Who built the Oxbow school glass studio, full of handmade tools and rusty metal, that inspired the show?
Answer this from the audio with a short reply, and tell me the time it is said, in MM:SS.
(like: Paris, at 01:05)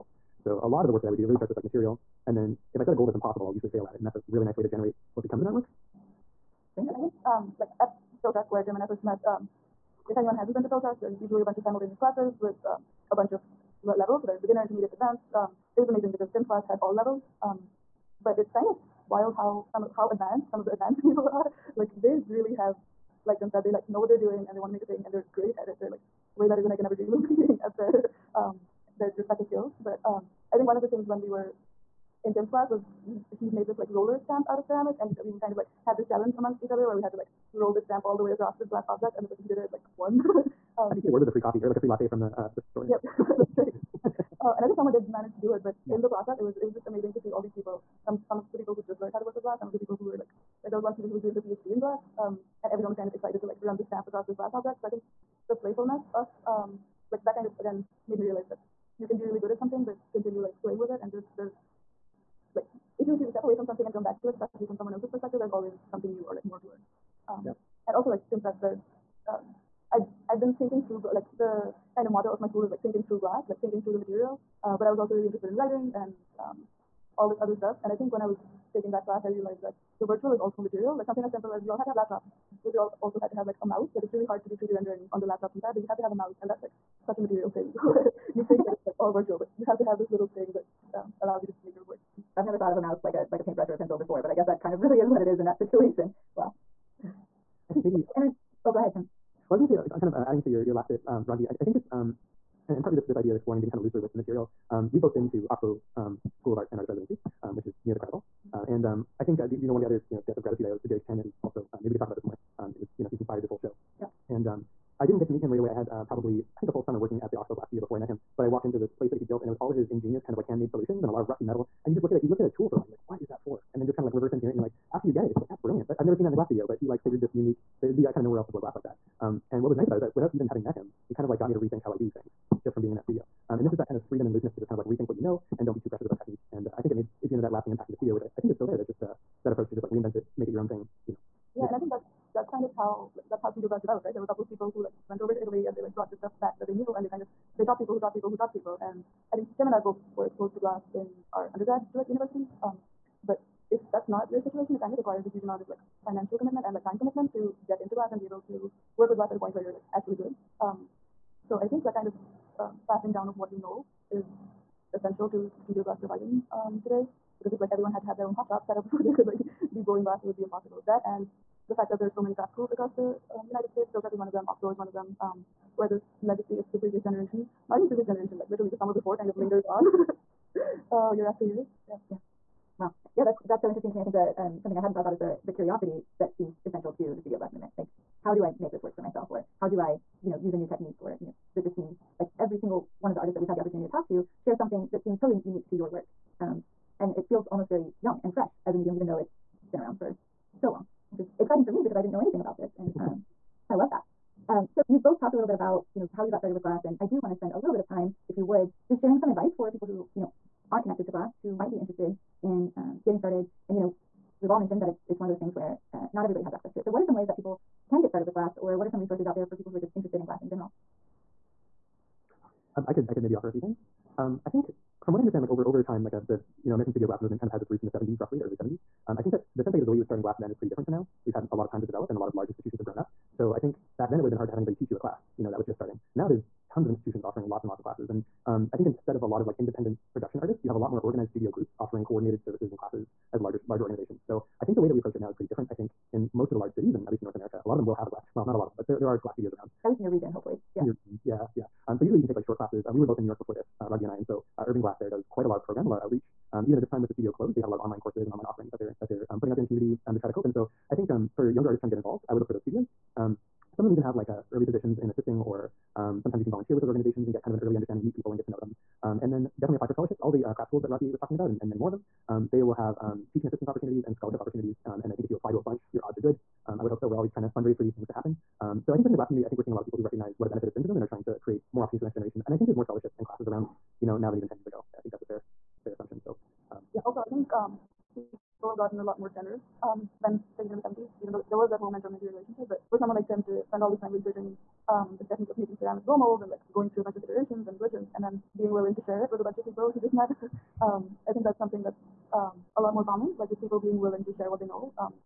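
Jerry Catania, at 01:50.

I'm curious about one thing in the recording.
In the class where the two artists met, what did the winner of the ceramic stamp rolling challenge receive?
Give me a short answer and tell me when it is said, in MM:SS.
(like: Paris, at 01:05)
a free coffee, at 00:41.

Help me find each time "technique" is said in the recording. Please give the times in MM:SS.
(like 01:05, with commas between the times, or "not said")
02:16, 03:10, 04:55.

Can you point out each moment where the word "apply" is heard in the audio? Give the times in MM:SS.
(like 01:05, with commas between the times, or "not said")
04:29, 04:35.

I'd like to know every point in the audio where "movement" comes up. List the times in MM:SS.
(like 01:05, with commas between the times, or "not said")
03:07, 03:47.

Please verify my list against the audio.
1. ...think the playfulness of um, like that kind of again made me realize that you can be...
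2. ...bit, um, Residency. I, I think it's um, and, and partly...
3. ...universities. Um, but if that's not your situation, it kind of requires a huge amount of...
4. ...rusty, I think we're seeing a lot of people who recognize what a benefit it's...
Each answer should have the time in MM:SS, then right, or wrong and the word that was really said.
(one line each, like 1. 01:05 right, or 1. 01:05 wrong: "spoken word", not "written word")
1. 00:54 right
2. 01:40 wrong: "Raghvi", not "Residency"
3. 02:32 right
4. 04:39 wrong: "community", not "rusty".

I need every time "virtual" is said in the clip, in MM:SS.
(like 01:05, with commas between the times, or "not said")
01:20, 01:29.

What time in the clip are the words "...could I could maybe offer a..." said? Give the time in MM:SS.
03:42.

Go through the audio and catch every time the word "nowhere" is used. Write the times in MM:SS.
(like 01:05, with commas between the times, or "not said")
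02:08.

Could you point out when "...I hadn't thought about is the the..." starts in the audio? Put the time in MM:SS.
03:04.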